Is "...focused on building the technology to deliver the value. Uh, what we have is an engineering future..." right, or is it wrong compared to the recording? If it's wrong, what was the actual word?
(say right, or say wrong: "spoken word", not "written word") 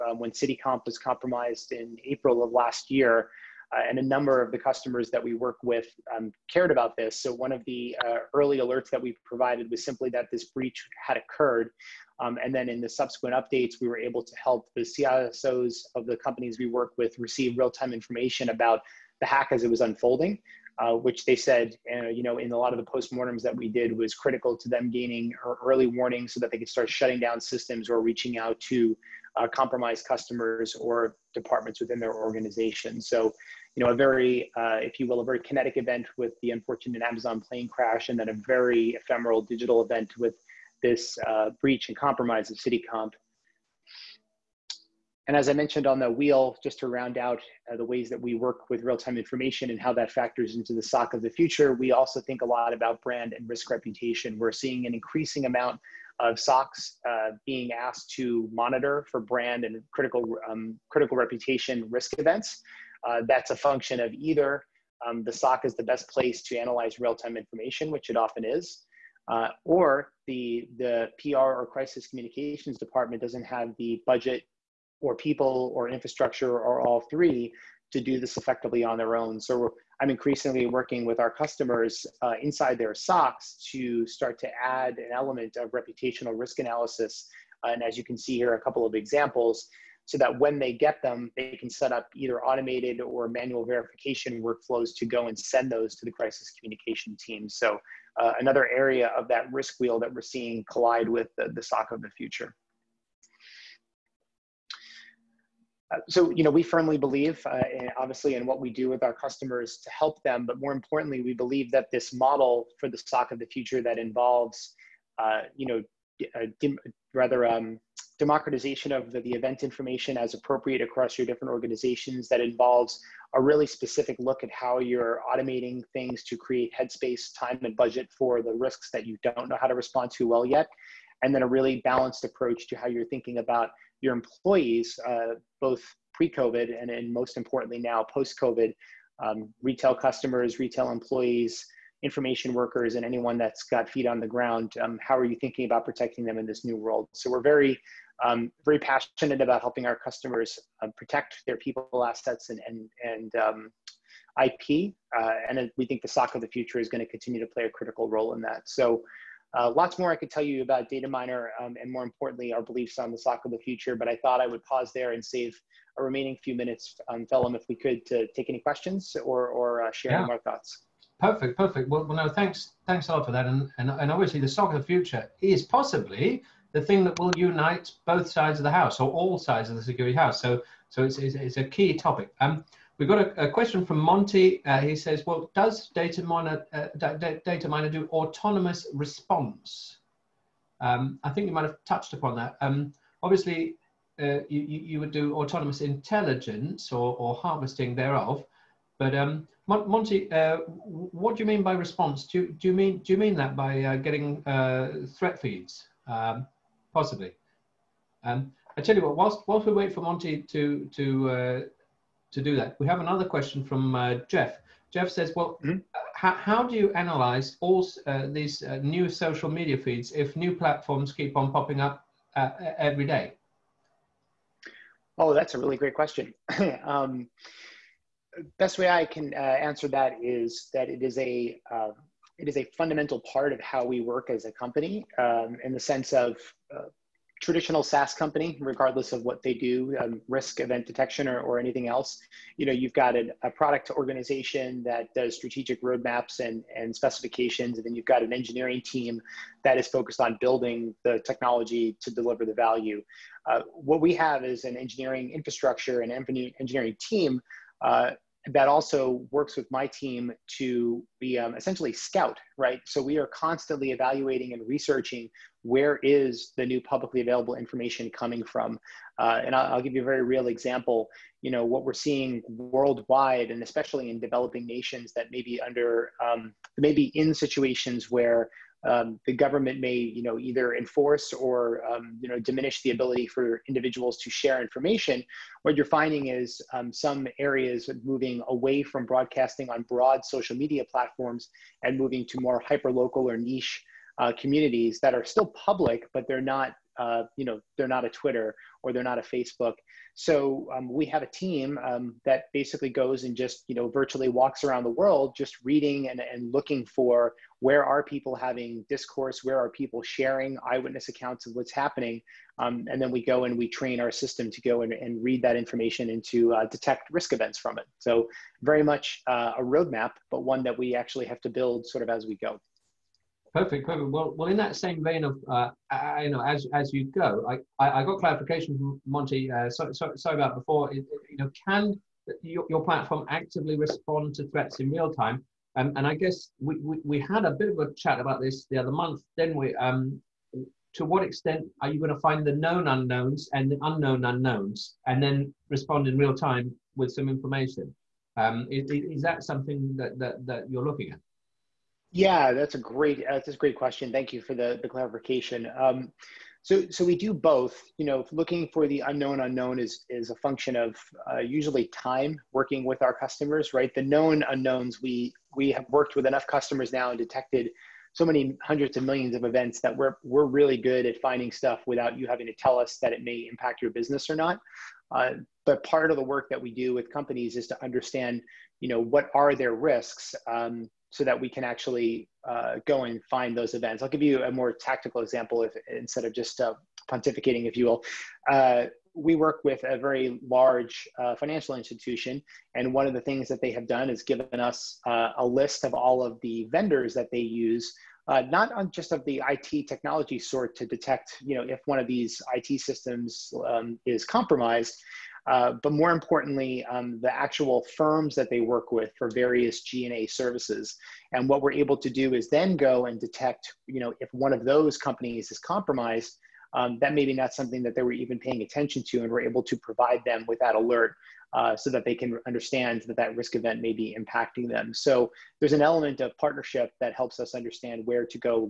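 wrong: "infrastructure", not "future".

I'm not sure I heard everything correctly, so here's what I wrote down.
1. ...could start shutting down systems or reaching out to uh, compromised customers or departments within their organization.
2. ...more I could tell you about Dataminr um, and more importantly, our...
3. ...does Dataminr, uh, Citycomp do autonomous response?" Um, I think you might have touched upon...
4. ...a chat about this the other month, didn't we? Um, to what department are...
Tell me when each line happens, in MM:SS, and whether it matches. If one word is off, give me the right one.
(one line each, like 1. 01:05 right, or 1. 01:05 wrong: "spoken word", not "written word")
1. 00:26 right
2. 02:39 right
3. 03:05 wrong: "Dataminr", not "Citycomp"
4. 05:37 wrong: "extent", not "department".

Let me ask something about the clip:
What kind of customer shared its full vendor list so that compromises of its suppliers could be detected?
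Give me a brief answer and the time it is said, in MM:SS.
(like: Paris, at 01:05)
financial institution, at 06:31.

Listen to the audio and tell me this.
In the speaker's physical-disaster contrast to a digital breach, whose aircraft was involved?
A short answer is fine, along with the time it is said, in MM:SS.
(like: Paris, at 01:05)
Amazon, at 00:37.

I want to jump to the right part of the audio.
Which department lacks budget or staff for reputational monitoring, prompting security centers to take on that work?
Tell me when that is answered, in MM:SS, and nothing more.
01:11.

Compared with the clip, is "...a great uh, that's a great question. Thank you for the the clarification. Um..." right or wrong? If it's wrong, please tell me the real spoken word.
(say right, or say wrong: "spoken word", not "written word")
right.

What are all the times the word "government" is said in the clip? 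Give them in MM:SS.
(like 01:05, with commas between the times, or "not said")
04:39.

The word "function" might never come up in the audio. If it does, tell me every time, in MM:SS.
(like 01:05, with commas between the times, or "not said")
01:03, 06:00.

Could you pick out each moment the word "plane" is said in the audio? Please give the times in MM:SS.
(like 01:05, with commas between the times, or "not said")
00:37.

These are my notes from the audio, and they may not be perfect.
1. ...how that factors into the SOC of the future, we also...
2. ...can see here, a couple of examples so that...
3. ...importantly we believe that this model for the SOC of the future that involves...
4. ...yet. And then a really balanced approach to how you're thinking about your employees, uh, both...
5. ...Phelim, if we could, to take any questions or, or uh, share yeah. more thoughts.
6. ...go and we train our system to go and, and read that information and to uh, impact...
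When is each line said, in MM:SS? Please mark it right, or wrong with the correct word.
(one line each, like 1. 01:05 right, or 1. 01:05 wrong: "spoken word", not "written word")
1. 00:49 right
2. 01:28 right
3. 01:50 right
4. 02:10 right
5. 02:47 right
6. 05:13 wrong: "detect", not "impact".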